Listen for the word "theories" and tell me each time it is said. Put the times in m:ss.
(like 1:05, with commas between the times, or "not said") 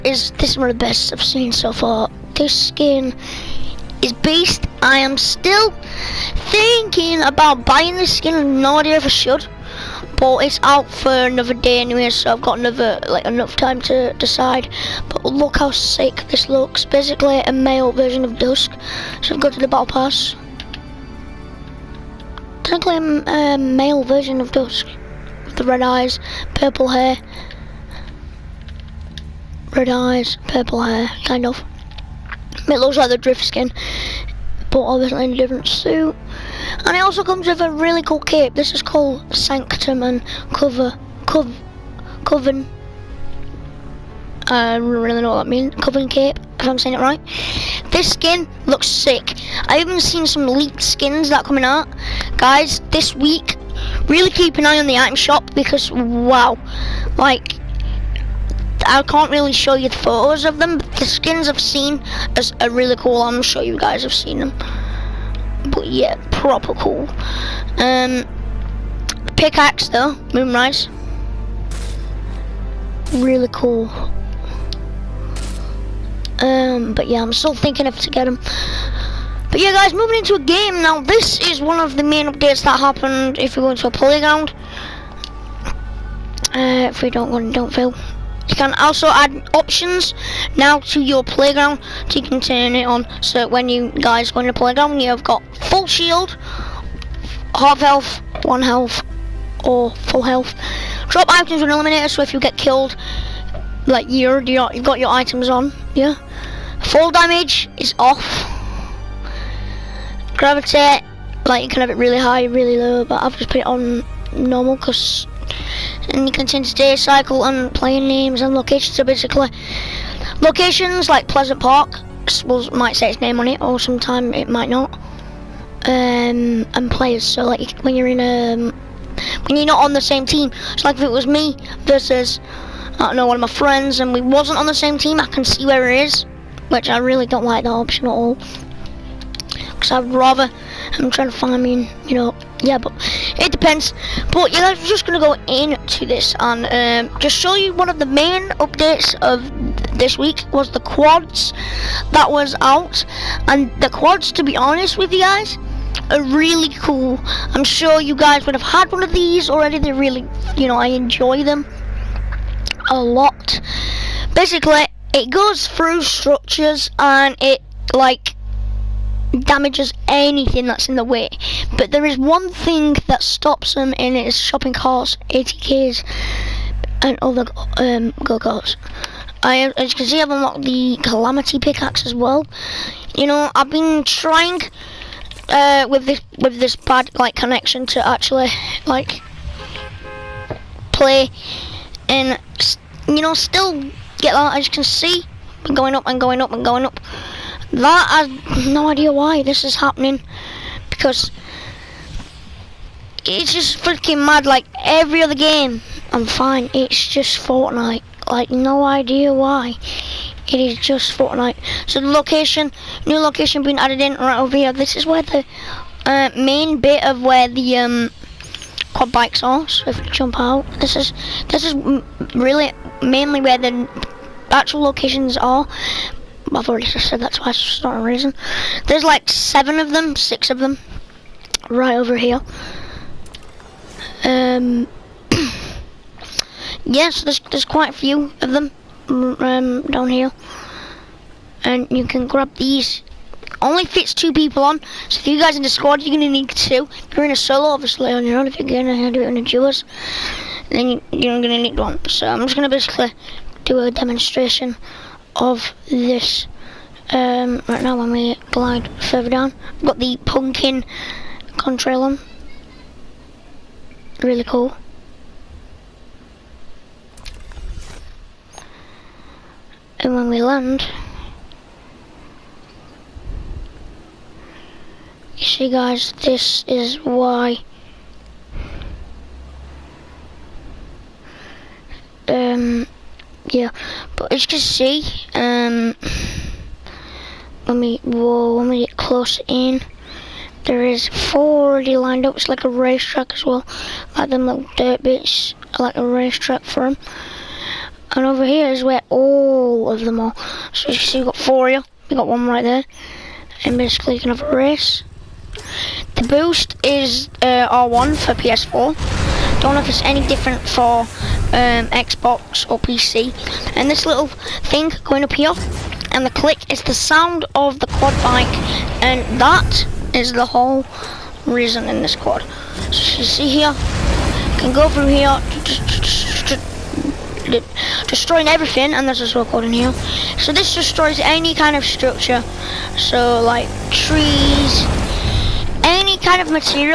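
not said.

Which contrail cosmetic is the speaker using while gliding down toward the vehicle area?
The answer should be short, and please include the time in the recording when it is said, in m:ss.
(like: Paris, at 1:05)
Pumpkin contrail, at 4:20.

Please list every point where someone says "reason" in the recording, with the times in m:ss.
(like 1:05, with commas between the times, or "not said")
3:48, 5:21.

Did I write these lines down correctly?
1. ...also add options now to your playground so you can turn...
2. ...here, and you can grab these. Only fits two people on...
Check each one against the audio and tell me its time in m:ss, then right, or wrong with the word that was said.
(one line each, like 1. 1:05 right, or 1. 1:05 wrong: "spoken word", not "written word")
1. 1:28 right
2. 4:00 right.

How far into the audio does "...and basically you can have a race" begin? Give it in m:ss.
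5:03.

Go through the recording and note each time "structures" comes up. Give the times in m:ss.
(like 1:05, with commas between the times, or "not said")
2:46, 5:31.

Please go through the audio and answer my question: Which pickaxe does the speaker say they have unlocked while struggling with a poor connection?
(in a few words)
Calamity.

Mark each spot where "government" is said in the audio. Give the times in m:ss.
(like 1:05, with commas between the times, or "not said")
not said.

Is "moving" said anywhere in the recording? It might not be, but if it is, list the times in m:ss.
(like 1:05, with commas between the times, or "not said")
1:19.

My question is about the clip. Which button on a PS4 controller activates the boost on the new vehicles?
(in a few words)
R1.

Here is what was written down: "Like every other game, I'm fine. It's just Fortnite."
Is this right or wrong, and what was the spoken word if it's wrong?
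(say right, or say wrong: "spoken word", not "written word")
right.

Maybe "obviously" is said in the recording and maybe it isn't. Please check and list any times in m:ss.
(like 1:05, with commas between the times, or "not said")
0:34, 4:07.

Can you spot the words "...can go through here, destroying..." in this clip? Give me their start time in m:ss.
5:24.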